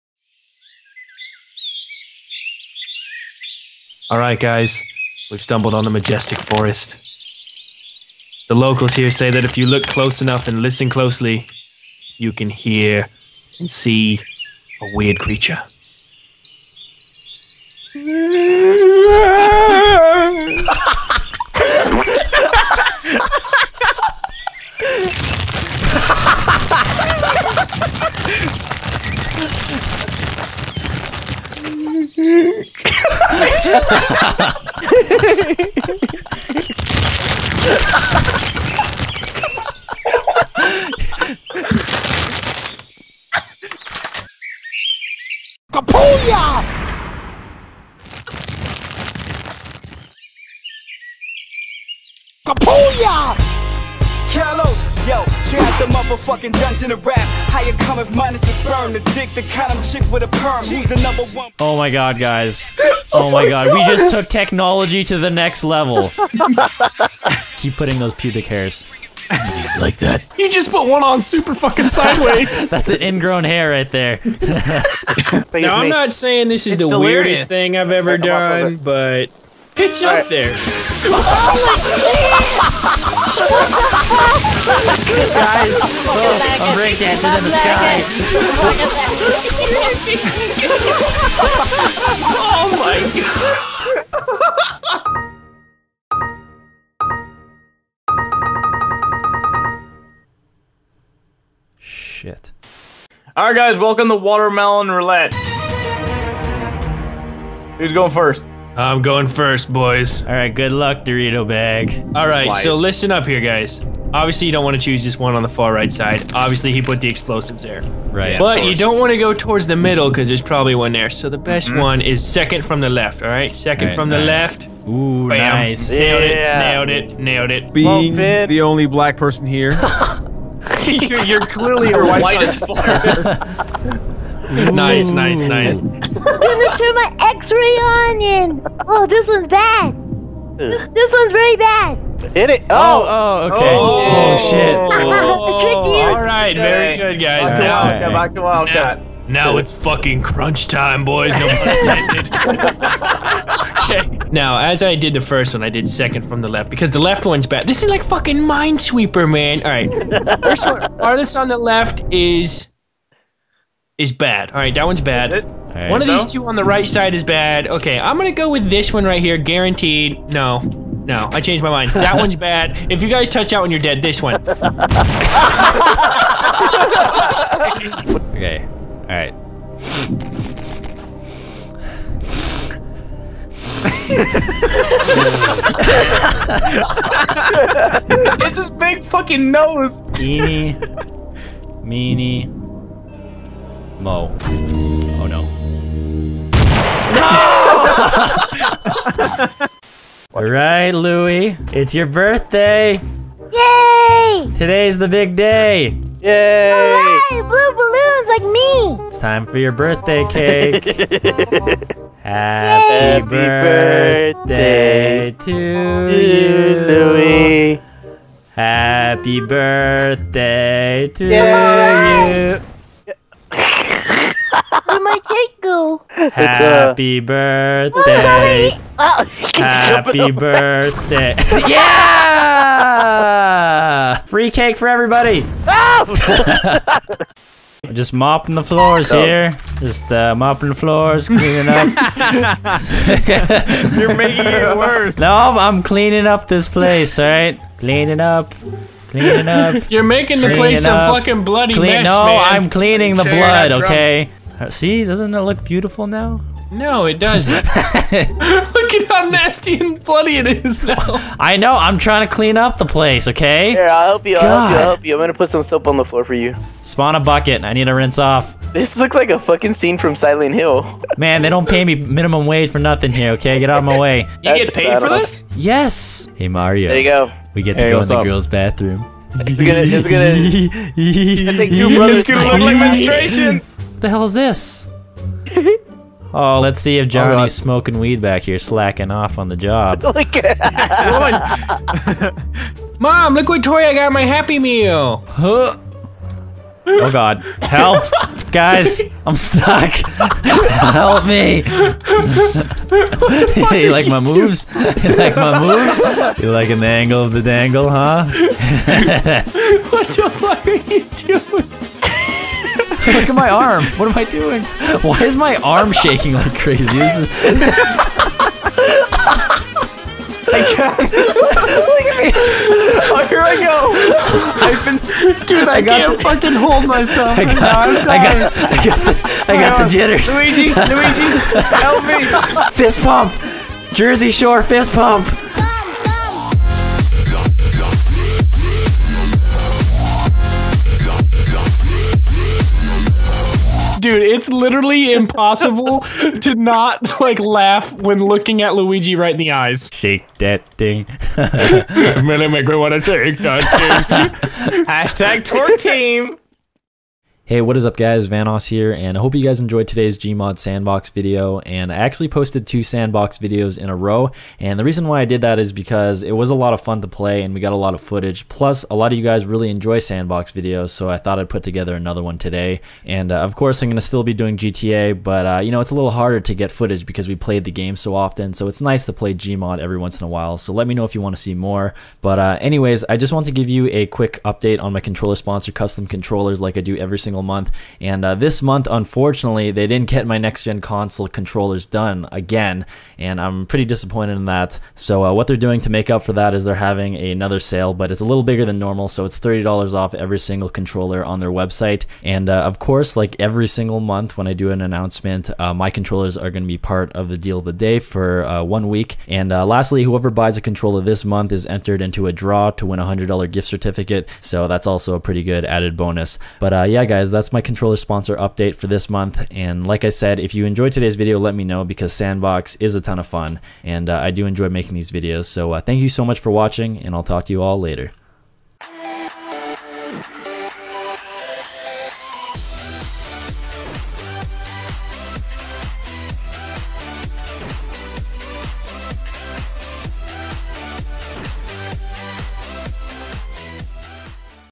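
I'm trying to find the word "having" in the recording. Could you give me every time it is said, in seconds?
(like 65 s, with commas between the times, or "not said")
396 s.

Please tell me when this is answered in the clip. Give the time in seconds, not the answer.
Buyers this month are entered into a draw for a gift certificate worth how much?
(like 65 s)
413 s.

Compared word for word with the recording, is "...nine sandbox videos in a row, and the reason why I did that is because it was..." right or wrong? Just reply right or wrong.
wrong.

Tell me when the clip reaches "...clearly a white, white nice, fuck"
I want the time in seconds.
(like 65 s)
131 s.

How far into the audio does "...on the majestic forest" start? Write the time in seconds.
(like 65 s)
5 s.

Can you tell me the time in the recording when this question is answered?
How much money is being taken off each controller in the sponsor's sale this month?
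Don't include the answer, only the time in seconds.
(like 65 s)
399 s.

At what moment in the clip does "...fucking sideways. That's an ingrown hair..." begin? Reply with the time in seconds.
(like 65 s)
71 s.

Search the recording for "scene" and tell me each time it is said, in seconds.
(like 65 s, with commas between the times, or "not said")
269 s.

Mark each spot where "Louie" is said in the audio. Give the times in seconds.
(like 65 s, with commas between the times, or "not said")
200 s, 216 s.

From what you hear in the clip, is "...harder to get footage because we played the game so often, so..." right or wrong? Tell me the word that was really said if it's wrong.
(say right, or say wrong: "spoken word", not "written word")
right.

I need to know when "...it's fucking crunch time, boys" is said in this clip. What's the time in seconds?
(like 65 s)
149 s.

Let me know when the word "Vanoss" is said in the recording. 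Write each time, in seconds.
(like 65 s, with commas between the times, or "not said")
358 s.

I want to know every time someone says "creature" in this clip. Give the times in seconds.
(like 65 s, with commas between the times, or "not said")
15 s.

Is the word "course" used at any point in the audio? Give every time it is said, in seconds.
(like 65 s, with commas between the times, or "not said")
373 s, 402 s.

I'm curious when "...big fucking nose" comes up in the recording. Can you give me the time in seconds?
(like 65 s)
188 s.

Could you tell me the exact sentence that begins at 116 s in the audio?
Obviously, he put the explosives there.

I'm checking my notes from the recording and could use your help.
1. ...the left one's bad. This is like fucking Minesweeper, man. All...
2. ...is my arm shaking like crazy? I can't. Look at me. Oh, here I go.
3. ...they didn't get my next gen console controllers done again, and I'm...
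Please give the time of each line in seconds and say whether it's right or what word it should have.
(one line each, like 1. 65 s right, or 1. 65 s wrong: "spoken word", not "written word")
1. 156 s right
2. 315 s right
3. 389 s right.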